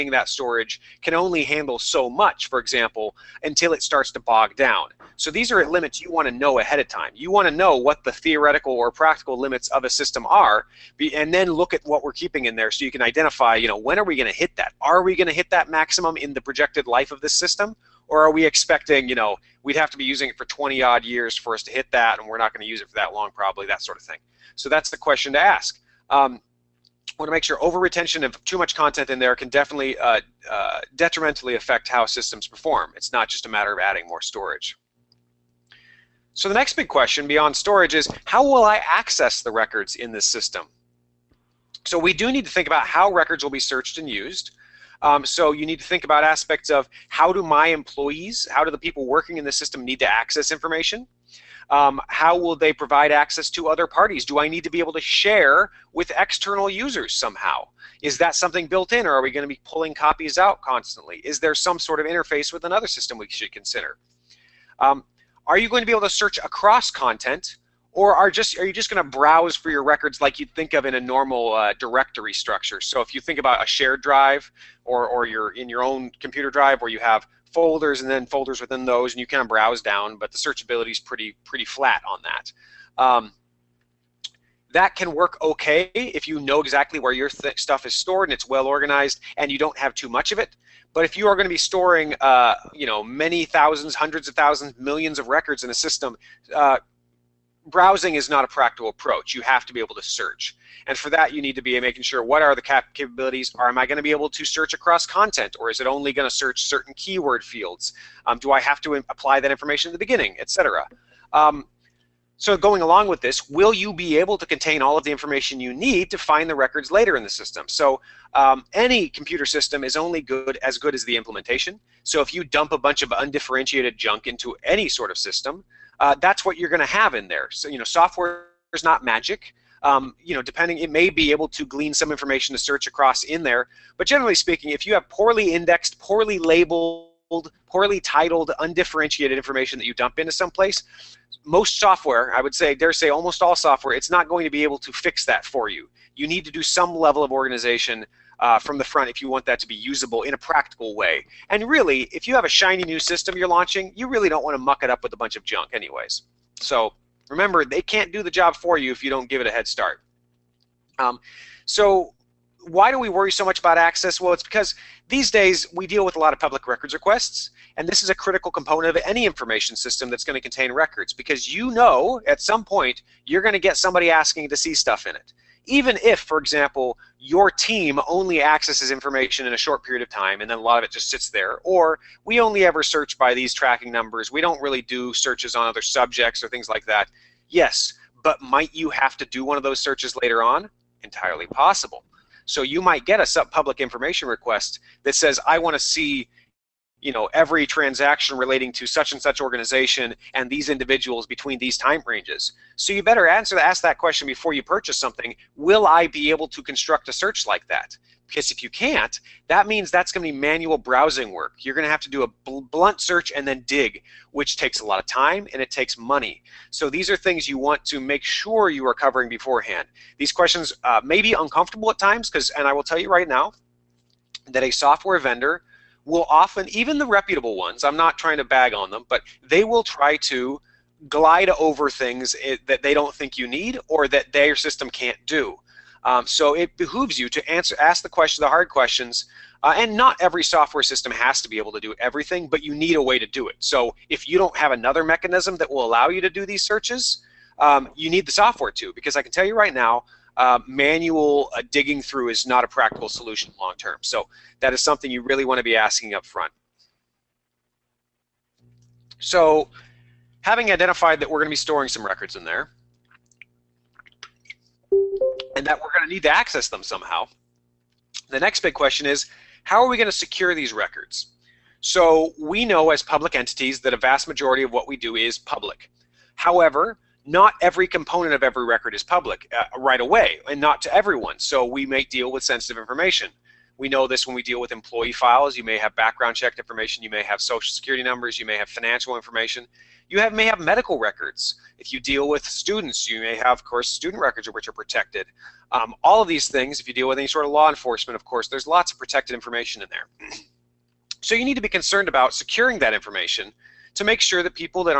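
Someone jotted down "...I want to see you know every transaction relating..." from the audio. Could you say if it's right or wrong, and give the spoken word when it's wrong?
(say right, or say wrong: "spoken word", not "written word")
right.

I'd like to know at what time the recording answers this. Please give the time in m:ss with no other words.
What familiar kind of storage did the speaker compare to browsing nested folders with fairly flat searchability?
1:13.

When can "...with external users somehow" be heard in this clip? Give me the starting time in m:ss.
0:55.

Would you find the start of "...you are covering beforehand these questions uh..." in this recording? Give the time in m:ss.
3:38.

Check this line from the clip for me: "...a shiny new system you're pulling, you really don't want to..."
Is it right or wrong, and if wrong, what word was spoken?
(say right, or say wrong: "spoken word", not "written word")
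wrong: "launching", not "pulling".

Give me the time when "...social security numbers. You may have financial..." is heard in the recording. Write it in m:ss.
4:47.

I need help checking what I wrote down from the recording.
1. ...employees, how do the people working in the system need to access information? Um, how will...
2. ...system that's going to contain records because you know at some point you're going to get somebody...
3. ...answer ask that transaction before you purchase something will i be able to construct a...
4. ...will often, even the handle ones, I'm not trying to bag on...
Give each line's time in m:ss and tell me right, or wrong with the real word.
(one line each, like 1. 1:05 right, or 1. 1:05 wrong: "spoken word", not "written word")
1. 0:47 right
2. 2:49 right
3. 3:23 wrong: "question", not "transaction"
4. 3:46 wrong: "reputable", not "handle".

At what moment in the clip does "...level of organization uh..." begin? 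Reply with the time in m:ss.
2:26.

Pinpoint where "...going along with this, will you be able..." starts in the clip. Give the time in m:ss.
1:52.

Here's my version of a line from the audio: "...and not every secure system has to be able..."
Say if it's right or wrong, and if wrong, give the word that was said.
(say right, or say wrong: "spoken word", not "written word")
wrong: "software", not "secure".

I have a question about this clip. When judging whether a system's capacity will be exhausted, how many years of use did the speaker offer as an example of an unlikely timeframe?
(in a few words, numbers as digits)
20.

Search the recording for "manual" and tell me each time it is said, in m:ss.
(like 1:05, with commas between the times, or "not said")
3:30, 4:10.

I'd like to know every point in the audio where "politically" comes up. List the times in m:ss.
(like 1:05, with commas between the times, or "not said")
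not said.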